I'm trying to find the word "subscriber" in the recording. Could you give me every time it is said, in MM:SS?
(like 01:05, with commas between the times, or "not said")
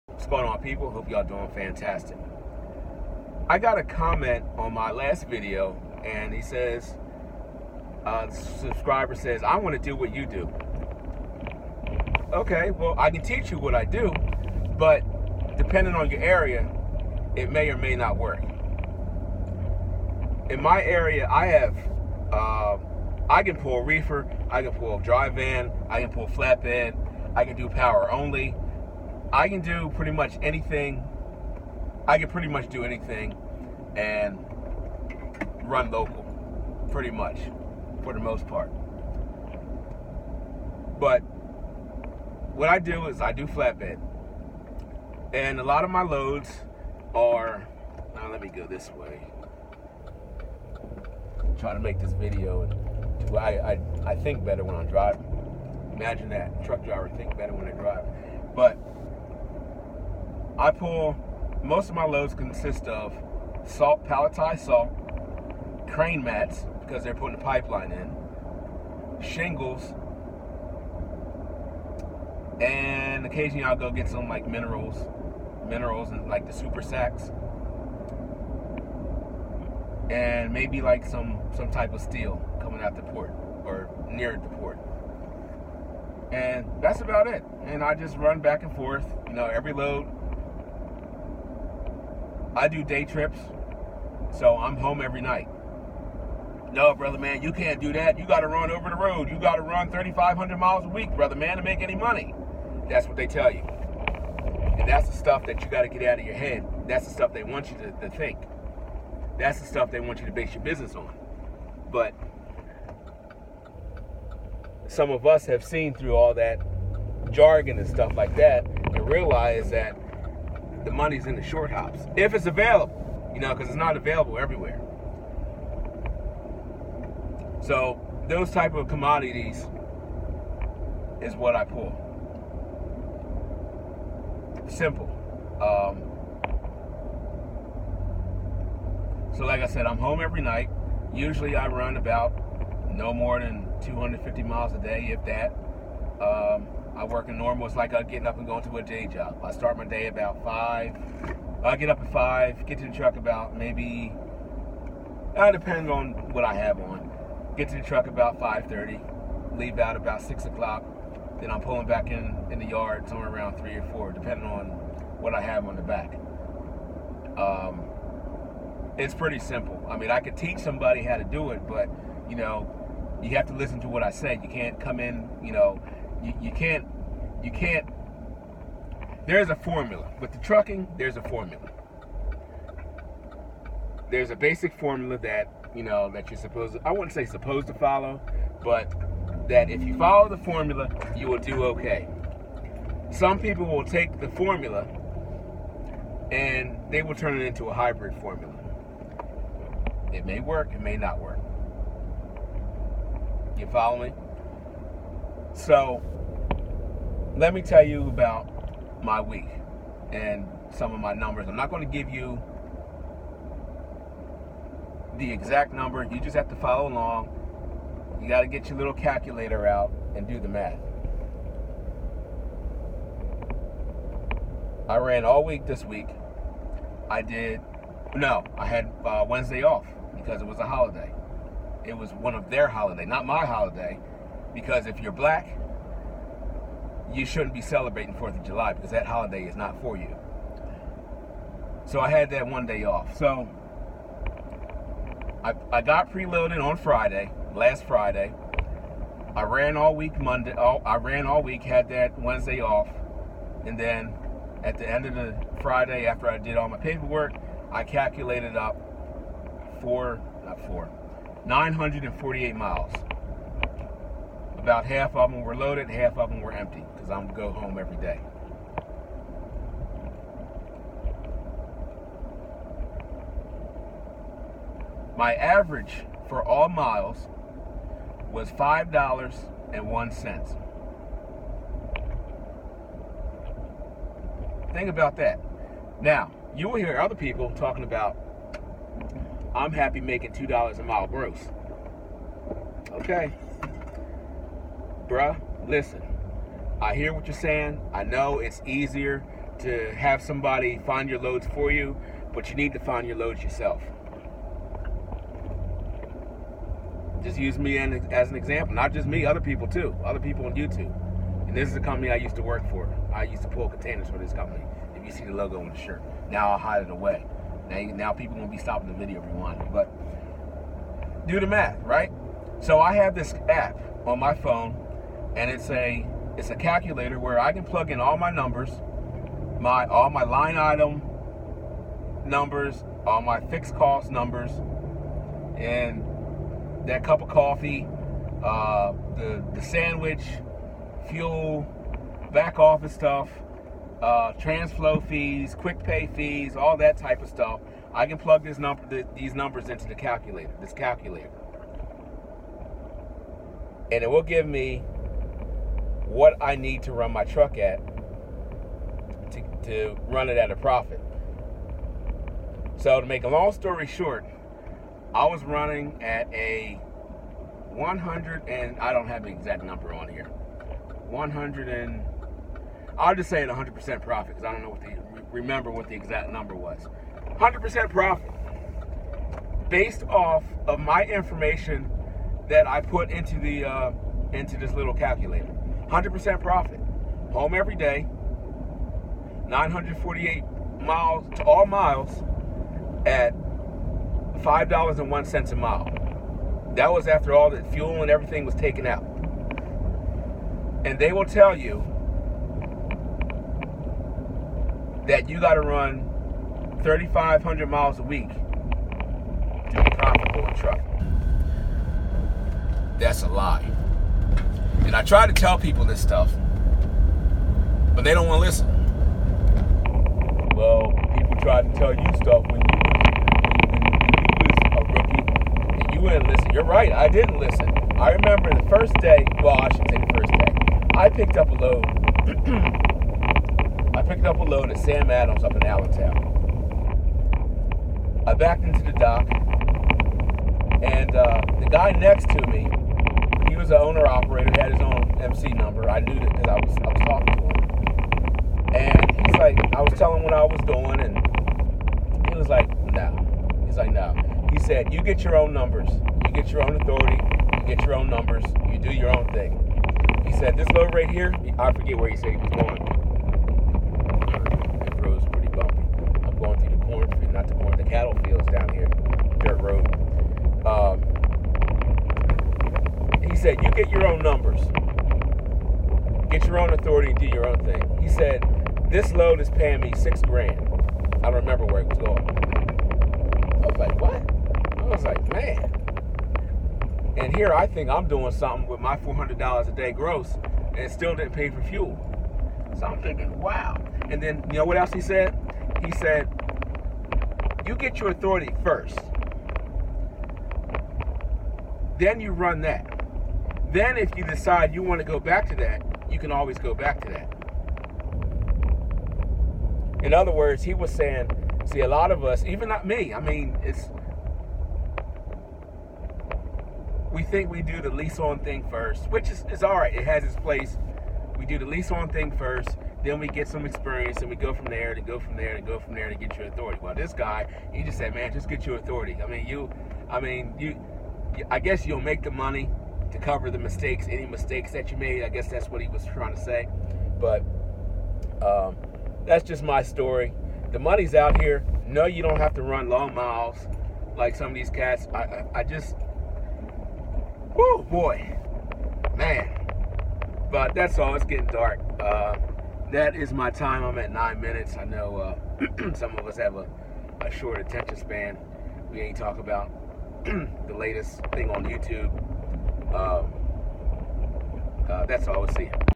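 00:08.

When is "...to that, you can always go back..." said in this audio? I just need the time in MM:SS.
08:25.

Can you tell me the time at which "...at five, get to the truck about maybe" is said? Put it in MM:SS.
02:32.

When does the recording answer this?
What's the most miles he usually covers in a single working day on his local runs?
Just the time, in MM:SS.
02:22.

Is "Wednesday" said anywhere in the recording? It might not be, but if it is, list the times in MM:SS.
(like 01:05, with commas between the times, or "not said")
03:49, 04:12.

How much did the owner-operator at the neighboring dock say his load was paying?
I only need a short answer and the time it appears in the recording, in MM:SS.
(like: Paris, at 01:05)
6 grand, at 07:59.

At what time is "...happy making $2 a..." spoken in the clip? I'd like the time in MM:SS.
04:49.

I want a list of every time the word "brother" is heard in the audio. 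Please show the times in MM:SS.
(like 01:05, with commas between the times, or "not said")
01:36, 01:41.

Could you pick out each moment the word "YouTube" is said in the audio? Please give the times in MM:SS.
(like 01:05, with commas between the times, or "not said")
05:10, 09:21.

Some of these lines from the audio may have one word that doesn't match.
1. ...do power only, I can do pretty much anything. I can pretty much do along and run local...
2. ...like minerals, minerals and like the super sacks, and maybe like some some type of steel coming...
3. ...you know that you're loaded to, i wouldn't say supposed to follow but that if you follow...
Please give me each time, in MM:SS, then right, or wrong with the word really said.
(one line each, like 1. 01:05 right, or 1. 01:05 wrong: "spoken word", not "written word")
1. 00:27 wrong: "anything", not "along"
2. 01:14 right
3. 03:05 wrong: "supposed", not "loaded".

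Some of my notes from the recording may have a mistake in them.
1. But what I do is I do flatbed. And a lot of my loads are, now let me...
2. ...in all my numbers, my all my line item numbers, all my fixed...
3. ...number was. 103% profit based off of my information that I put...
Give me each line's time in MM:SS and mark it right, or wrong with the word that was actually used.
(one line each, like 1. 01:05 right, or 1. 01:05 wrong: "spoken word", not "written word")
1. 00:40 right
2. 05:27 right
3. 06:16 wrong: "100", not "103".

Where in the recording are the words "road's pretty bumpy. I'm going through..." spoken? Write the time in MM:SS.
07:45.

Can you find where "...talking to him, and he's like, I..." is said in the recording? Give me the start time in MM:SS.
07:27.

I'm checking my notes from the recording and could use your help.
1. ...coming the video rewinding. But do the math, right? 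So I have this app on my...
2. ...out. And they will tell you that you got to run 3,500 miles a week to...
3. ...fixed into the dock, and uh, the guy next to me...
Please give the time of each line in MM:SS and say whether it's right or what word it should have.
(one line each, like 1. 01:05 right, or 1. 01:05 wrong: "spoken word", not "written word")
1. 05:18 wrong: "stopping", not "coming"
2. 06:38 right
3. 07:18 wrong: "backed", not "fixed".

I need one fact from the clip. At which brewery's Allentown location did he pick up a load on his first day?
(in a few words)
Sam Adams.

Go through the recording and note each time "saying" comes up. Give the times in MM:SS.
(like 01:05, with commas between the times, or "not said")
04:57, 08:30.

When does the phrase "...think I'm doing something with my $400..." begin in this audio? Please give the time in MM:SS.
08:07.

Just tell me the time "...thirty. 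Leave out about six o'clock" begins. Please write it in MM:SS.
02:38.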